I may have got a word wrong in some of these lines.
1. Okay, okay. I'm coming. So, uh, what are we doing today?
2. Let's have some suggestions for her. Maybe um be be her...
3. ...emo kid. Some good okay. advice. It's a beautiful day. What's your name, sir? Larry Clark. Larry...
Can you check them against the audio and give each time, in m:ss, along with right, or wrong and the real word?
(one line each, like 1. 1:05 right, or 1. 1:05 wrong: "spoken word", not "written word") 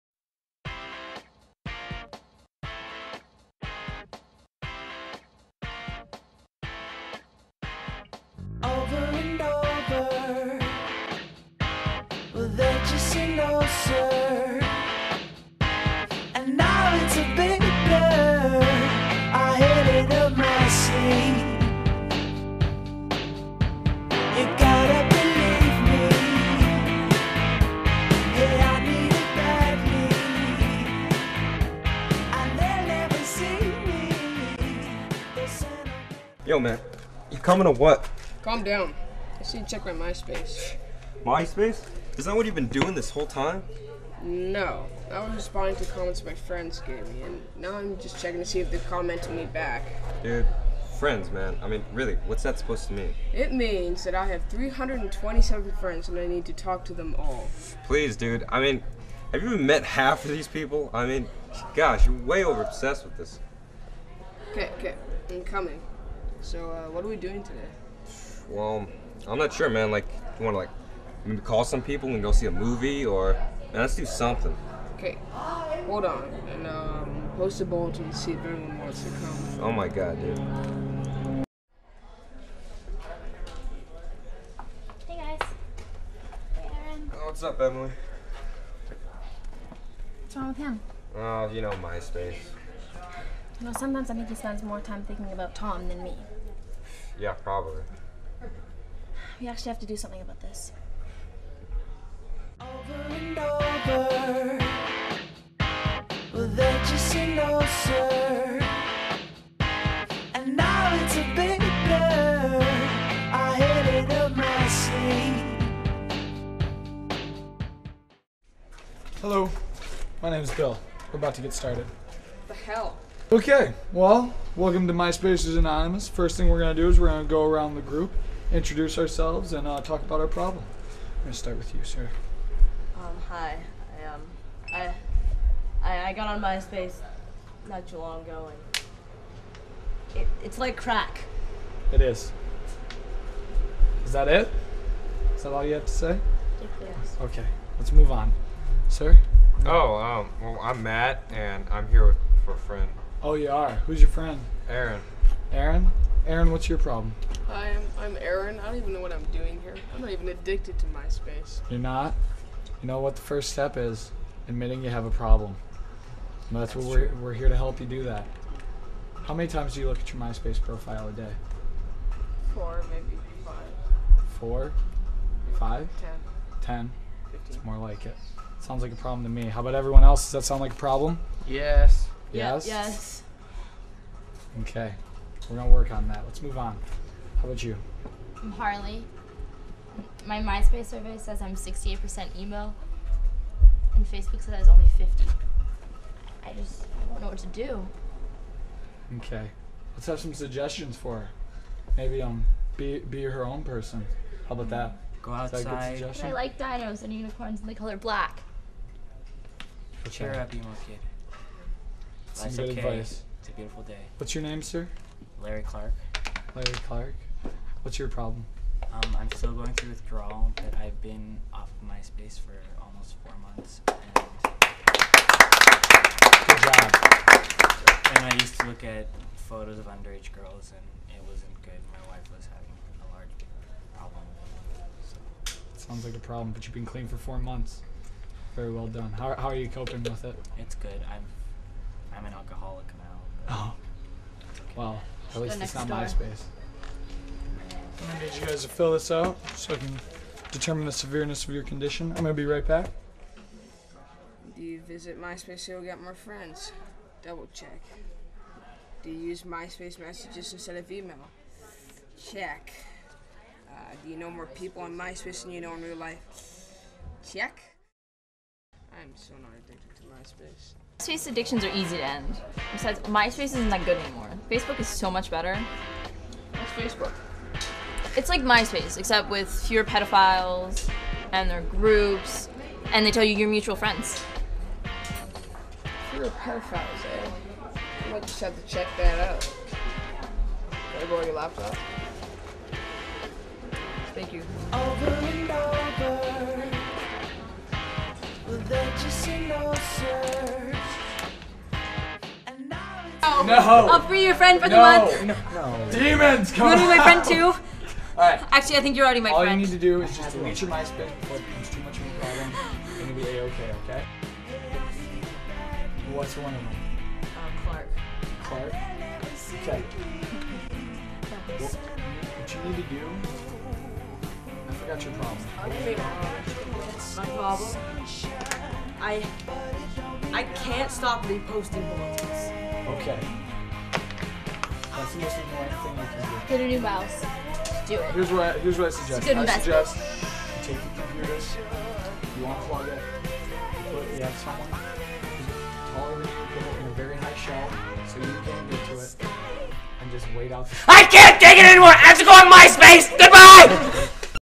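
1. 1:04 right
2. 3:19 right
3. 3:30 right.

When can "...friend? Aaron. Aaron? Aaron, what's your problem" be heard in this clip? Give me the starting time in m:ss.
2:34.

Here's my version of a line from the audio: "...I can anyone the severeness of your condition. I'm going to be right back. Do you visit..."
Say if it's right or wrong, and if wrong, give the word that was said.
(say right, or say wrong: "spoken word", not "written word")
wrong: "determine", not "anyone".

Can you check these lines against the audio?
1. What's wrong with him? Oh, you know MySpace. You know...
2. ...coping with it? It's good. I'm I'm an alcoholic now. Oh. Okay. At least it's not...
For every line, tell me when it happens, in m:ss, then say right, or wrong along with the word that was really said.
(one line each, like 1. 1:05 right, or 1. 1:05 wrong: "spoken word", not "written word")
1. 1:30 right
2. 3:59 right.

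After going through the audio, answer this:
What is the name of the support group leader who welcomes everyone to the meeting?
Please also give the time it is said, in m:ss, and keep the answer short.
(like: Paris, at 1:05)
Bill, at 2:00.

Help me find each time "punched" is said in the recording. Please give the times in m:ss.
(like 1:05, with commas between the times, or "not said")
not said.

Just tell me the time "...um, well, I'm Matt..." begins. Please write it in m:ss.
2:29.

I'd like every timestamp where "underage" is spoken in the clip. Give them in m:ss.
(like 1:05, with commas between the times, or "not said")
3:49.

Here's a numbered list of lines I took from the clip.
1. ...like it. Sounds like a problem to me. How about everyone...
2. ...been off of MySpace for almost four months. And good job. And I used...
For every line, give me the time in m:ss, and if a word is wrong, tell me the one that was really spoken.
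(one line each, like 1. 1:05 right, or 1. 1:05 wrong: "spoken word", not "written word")
1. 2:57 right
2. 3:41 right.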